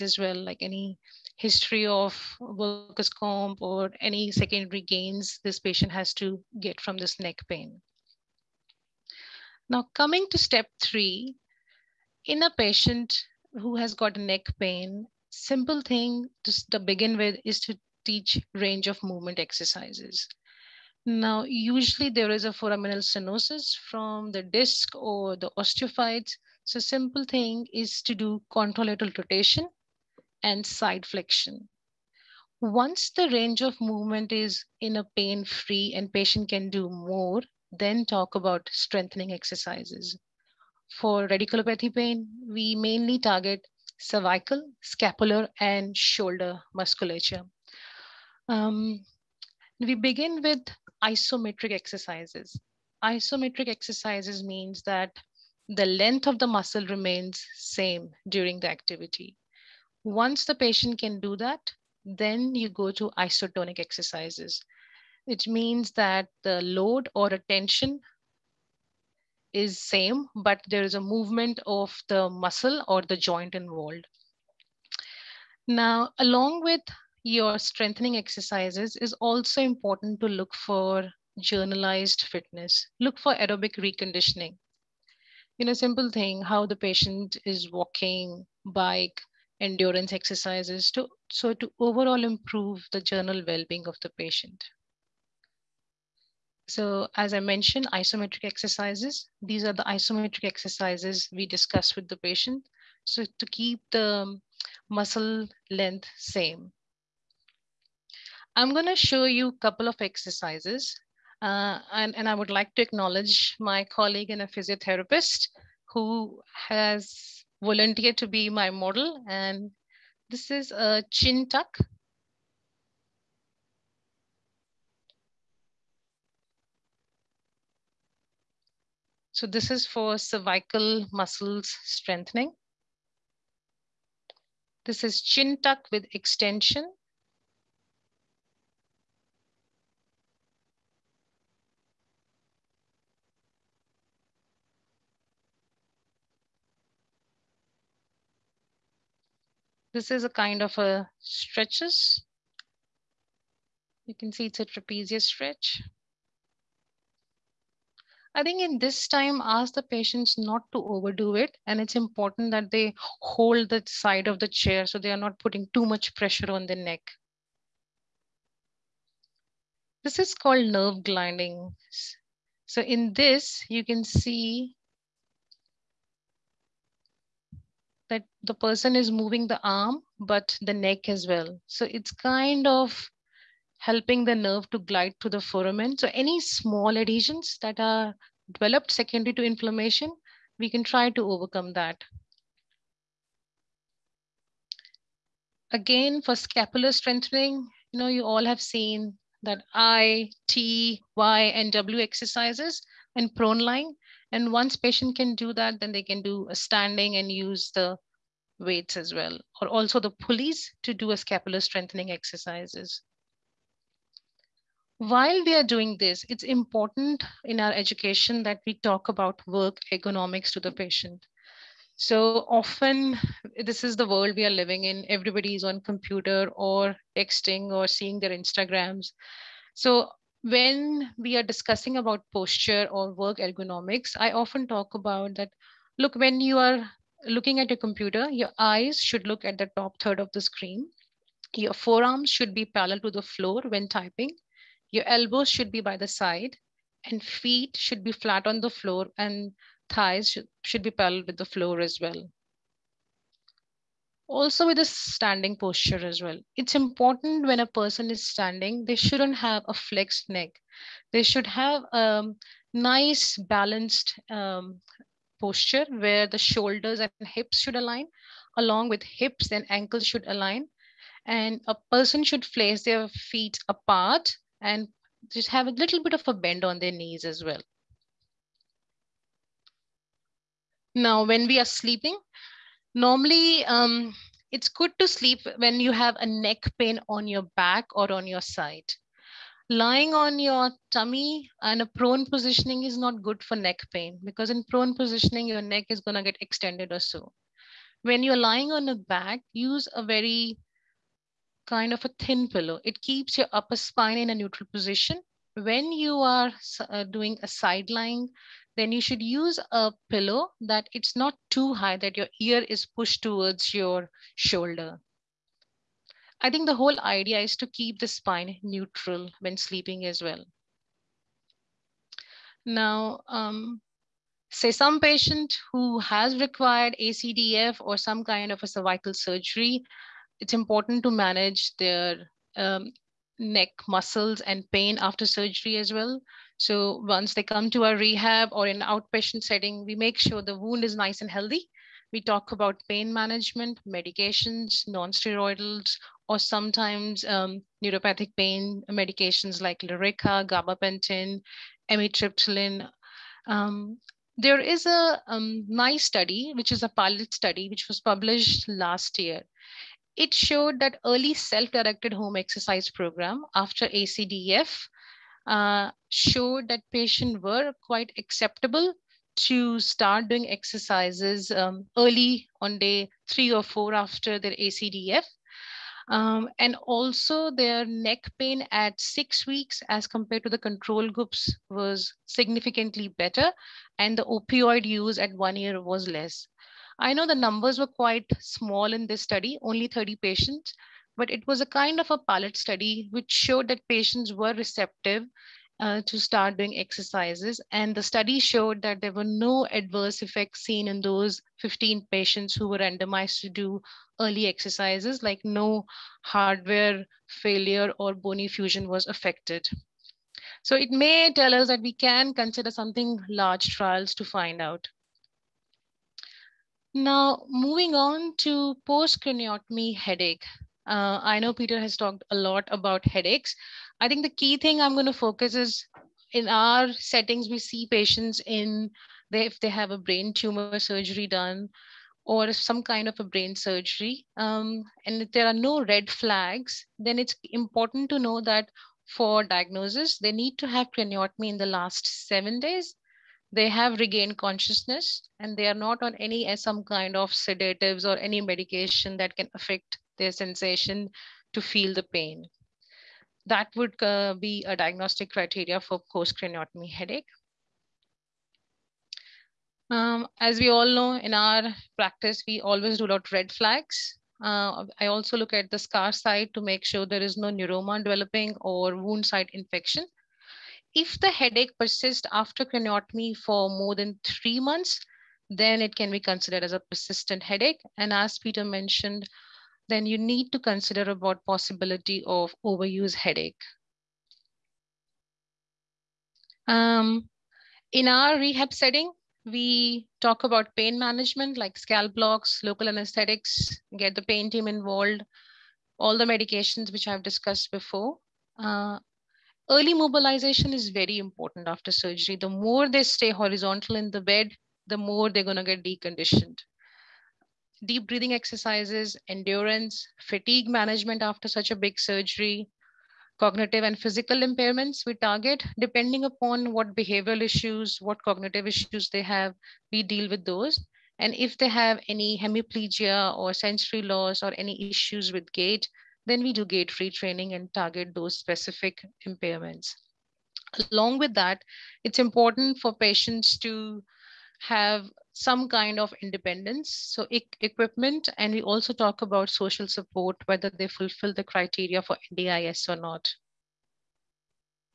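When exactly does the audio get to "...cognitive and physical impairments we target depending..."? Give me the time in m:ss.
8:33.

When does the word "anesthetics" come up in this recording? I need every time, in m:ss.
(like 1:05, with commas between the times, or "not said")
8:12.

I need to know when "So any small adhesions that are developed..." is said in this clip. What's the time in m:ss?
3:05.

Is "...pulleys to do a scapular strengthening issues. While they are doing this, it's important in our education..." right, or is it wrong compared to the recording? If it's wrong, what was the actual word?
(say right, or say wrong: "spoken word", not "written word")
wrong: "exercises", not "issues".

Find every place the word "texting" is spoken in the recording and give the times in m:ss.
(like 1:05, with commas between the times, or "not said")
3:47.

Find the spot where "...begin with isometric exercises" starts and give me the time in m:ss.
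0:49.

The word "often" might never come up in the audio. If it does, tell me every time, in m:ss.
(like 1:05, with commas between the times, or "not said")
3:42, 3:54.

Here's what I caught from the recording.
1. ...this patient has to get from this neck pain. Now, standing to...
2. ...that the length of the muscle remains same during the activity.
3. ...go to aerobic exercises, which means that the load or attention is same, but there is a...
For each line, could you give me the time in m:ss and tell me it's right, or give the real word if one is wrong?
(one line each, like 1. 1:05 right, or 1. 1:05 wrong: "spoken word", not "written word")
1. 0:05 wrong: "coming", not "standing"
2. 0:54 right
3. 1:02 wrong: "isotonic", not "aerobic".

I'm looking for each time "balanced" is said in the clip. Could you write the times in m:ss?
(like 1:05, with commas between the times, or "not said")
4:23.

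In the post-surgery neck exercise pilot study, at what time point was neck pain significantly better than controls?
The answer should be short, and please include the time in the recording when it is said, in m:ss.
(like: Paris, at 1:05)
Six weeks, at 6:18.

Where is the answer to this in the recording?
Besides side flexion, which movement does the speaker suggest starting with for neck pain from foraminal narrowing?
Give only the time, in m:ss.
0:28.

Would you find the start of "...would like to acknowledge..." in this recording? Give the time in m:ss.
1:52.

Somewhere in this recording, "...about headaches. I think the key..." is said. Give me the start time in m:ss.
7:02.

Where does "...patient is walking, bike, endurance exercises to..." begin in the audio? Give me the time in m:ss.
1:26.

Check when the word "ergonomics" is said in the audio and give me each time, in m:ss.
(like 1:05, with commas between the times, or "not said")
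3:39, 3:53.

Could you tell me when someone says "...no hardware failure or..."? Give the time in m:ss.
6:45.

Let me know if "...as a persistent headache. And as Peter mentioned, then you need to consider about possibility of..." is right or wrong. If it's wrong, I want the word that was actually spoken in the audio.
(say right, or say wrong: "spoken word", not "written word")
right.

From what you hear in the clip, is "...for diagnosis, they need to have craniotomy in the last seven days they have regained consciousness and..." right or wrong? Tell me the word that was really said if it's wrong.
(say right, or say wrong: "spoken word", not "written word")
right.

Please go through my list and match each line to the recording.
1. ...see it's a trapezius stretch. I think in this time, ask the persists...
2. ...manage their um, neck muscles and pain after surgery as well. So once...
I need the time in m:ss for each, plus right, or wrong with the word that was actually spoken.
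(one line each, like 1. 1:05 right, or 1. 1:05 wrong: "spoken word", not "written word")
1. 2:34 wrong: "patients", not "persists"
2. 5:31 right.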